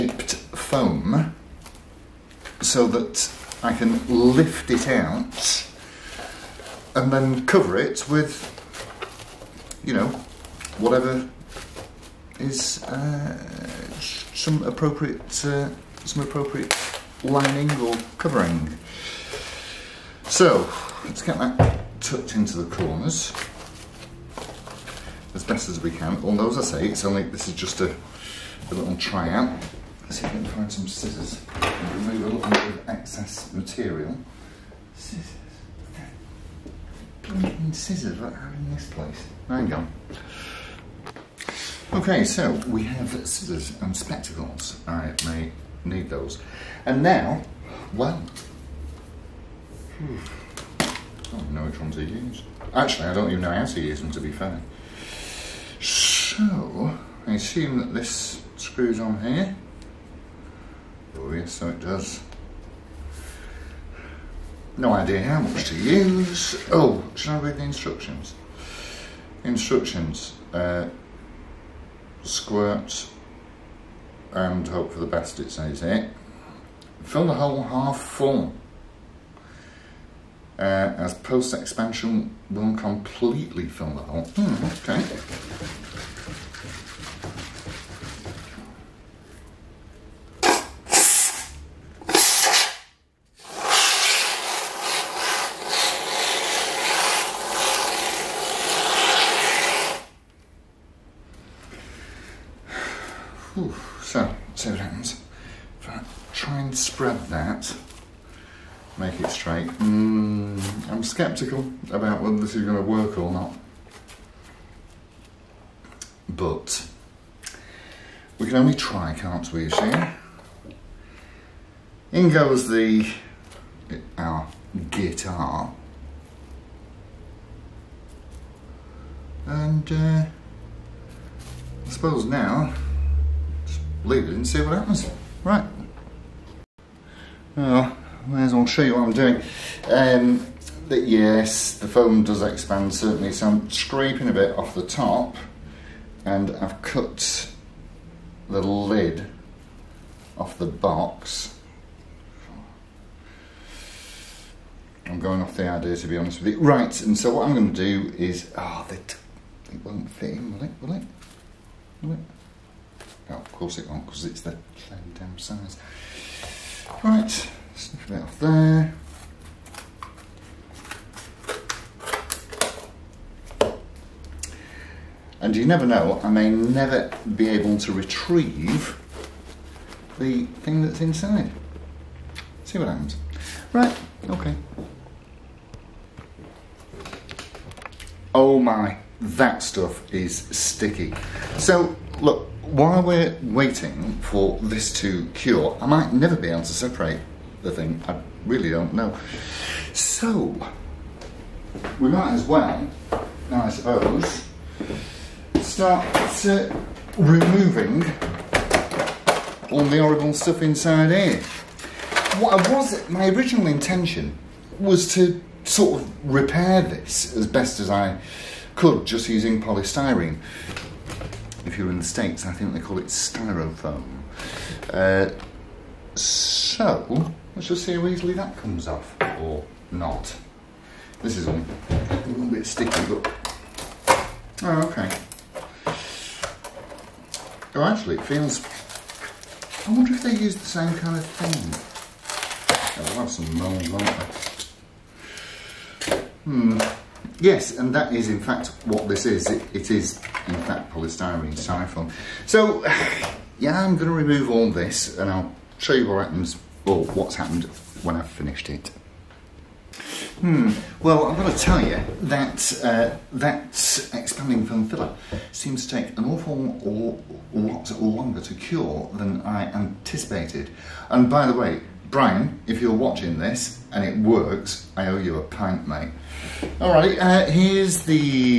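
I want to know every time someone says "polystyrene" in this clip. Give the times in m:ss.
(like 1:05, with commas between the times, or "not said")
3:39, 4:10.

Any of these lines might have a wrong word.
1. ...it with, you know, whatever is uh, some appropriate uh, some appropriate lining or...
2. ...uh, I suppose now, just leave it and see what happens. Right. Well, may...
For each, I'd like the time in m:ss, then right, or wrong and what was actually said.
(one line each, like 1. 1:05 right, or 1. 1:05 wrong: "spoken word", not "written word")
1. 0:07 right
2. 2:09 right.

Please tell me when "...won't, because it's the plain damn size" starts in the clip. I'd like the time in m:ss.
2:43.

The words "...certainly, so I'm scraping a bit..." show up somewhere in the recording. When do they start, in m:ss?
2:22.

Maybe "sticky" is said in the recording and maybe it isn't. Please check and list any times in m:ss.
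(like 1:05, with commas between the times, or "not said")
3:10, 3:52.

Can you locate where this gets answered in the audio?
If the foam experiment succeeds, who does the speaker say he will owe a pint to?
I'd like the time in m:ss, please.
4:32.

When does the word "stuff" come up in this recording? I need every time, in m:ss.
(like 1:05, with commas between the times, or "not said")
3:09, 3:30.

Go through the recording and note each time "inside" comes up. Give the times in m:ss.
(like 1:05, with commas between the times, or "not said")
3:01, 3:30.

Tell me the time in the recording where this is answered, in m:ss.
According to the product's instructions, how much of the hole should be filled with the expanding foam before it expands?
1:17.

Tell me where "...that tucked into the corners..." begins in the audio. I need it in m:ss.
0:21.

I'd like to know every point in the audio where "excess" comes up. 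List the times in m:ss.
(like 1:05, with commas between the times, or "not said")
0:32.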